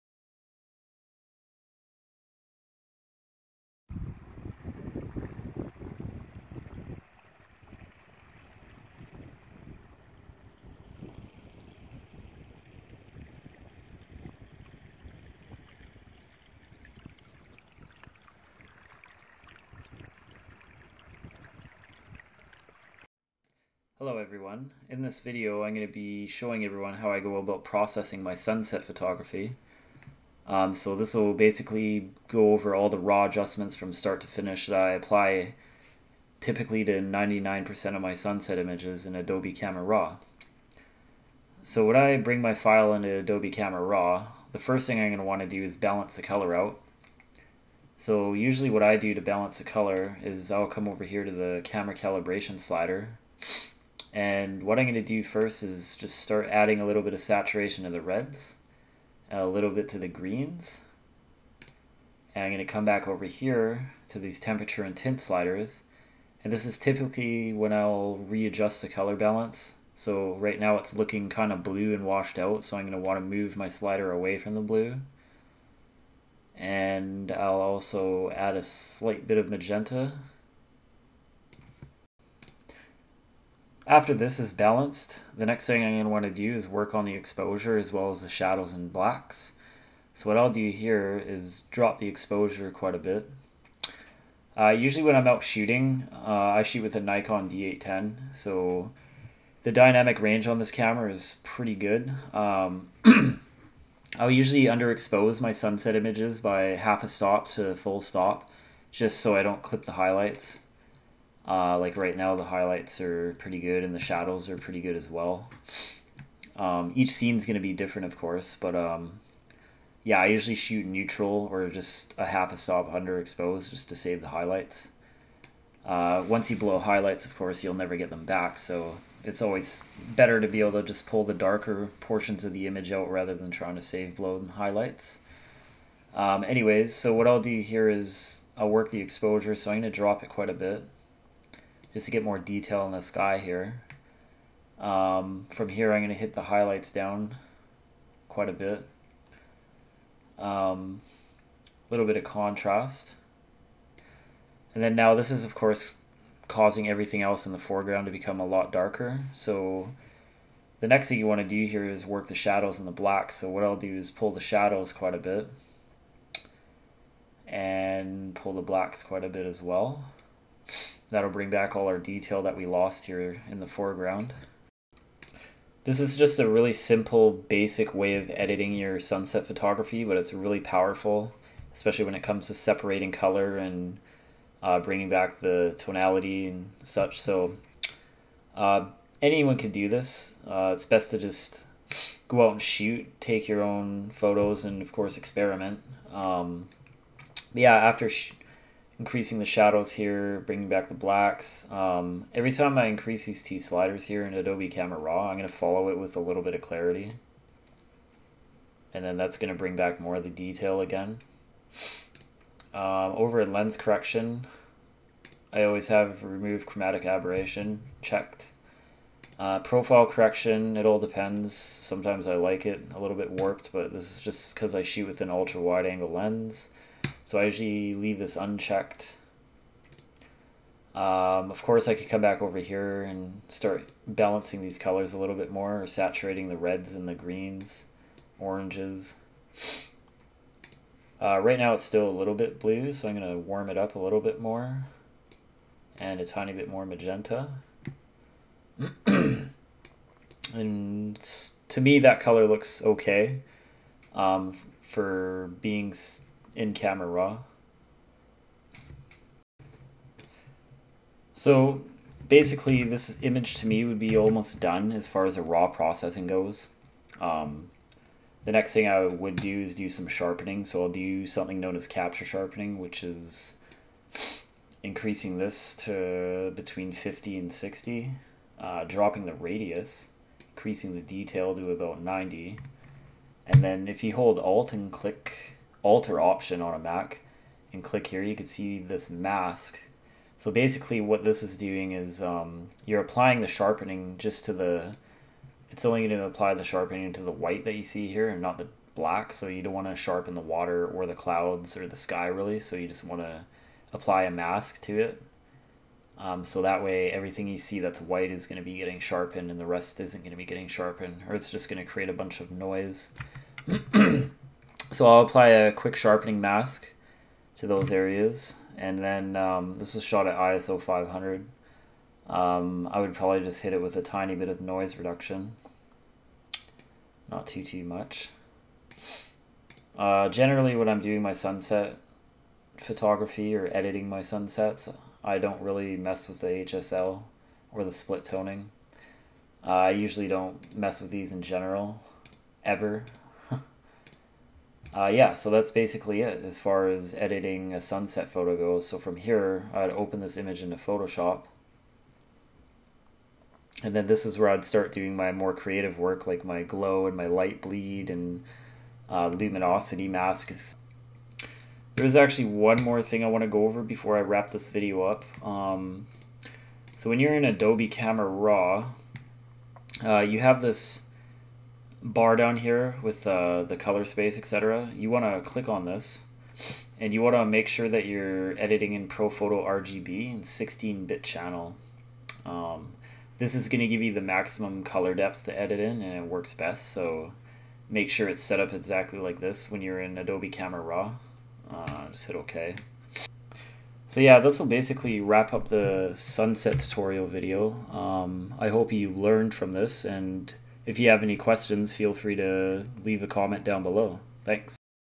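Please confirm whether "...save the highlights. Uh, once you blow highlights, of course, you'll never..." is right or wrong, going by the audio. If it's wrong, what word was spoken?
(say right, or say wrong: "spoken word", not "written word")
right.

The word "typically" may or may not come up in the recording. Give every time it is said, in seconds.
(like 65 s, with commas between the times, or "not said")
36 s, 66 s.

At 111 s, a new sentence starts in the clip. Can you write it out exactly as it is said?
Uh, like right now, the highlights are pretty good and the shadows are pretty good as well.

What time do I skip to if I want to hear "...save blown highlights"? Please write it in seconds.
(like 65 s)
133 s.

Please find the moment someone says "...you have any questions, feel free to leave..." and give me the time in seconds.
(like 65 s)
400 s.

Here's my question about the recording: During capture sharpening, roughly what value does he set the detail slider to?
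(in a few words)
90.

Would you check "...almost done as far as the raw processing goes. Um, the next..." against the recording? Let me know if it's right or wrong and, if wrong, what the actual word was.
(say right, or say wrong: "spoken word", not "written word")
right.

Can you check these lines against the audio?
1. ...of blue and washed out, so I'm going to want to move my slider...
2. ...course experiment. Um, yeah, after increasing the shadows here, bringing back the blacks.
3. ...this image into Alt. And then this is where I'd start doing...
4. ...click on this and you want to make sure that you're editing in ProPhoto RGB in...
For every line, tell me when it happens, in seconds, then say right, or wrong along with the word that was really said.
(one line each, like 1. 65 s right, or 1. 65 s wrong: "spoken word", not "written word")
1. 71 s right
2. 194 s right
3. 350 s wrong: "Photoshop", not "Alt"
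4. 375 s right.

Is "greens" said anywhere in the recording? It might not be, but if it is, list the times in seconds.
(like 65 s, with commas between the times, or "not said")
60 s, 237 s.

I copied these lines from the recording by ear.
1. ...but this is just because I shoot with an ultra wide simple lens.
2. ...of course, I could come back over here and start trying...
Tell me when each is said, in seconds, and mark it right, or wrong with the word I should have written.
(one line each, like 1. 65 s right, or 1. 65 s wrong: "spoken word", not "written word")
1. 223 s wrong: "angle", not "simple"
2. 231 s wrong: "balancing", not "trying".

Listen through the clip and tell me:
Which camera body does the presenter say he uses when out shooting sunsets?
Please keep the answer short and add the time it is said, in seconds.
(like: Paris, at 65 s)
Nikon D810, at 97 s.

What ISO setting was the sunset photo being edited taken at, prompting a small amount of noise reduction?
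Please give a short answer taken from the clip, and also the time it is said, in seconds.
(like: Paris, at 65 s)
500, at 320 s.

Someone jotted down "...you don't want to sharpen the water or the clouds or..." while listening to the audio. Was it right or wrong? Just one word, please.
right.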